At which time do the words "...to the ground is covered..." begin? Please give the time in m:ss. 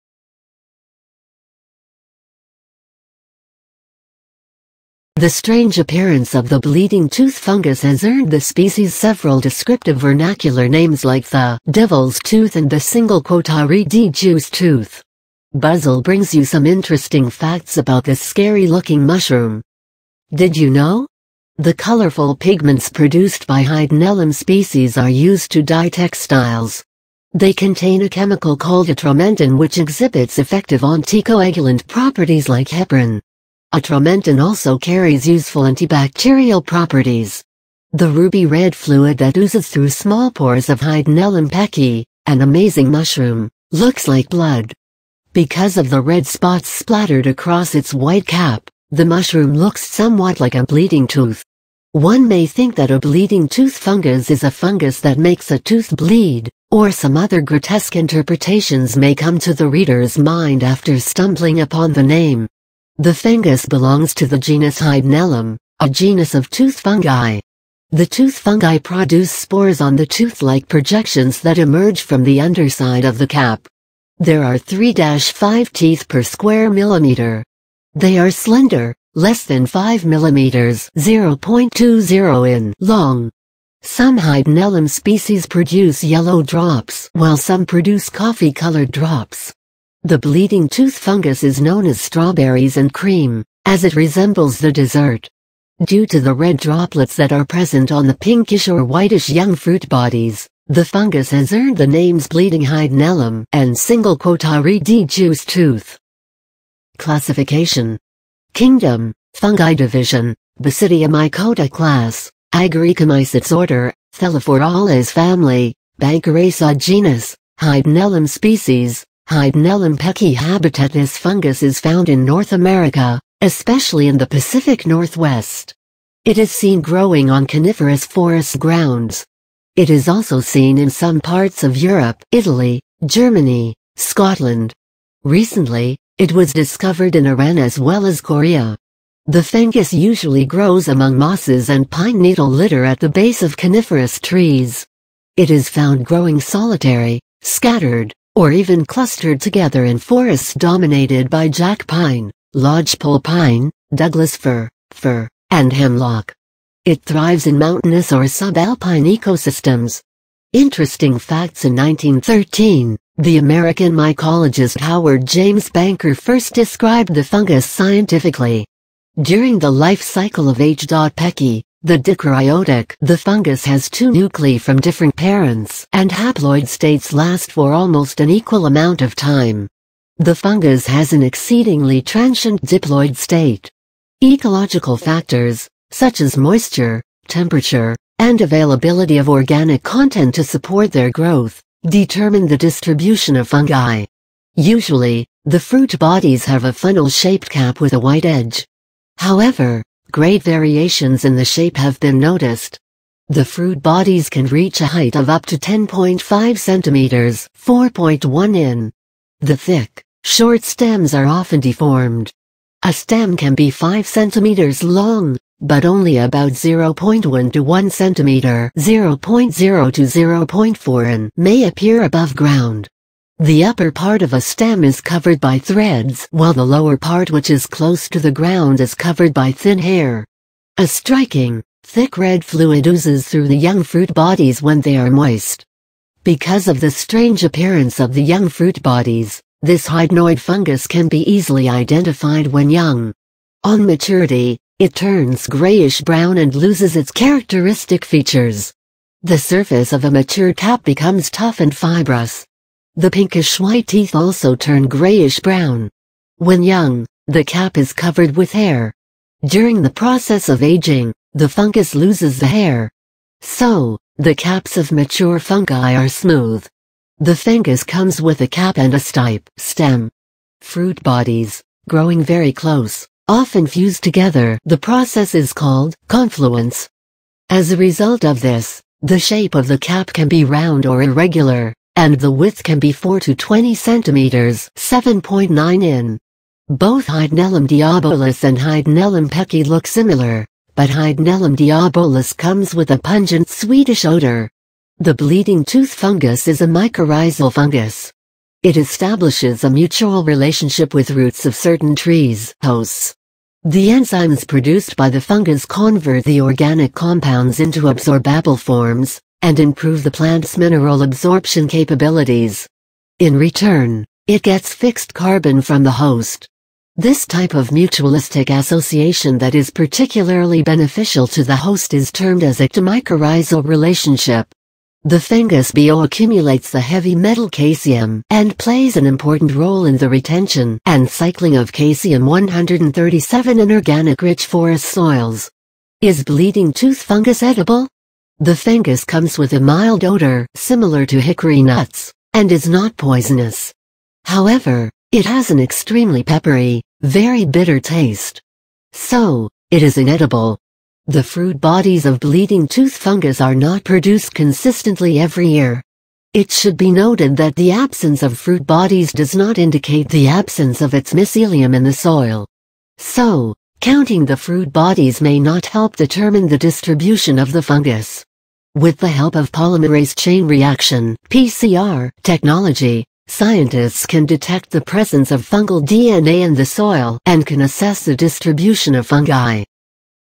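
3:48.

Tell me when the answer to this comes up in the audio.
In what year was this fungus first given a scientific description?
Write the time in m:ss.
2:41.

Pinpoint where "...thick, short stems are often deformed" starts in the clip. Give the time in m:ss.
3:29.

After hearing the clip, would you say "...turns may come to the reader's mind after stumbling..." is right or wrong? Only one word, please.
wrong.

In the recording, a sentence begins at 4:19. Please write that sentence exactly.
During the process of aging, the fungus loses the hair.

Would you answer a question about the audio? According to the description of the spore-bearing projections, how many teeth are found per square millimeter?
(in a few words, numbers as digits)
3-5.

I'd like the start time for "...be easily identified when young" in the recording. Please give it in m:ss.
4:01.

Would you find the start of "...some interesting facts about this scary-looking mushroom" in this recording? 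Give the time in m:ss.
0:16.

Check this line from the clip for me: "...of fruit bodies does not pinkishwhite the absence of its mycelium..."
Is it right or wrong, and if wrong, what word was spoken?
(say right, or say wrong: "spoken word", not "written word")
wrong: "indicate", not "pinkishwhite".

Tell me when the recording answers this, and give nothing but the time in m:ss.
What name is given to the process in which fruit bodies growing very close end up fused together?
4:36.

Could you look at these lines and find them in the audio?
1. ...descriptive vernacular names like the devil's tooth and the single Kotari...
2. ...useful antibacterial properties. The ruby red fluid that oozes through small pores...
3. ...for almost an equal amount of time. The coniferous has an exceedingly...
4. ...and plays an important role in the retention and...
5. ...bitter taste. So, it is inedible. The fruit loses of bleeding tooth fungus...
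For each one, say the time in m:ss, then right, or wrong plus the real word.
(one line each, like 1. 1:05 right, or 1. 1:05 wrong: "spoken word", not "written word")
1. 0:09 right
2. 0:35 right
3. 2:57 wrong: "fungus", not "coniferous"
4. 5:28 right
5. 5:47 wrong: "bodies", not "loses".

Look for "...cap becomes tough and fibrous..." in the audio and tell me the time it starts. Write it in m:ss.
4:10.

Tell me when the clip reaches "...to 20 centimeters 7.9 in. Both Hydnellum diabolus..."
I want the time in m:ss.
4:43.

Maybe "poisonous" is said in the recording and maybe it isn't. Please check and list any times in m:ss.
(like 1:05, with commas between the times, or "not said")
5:42.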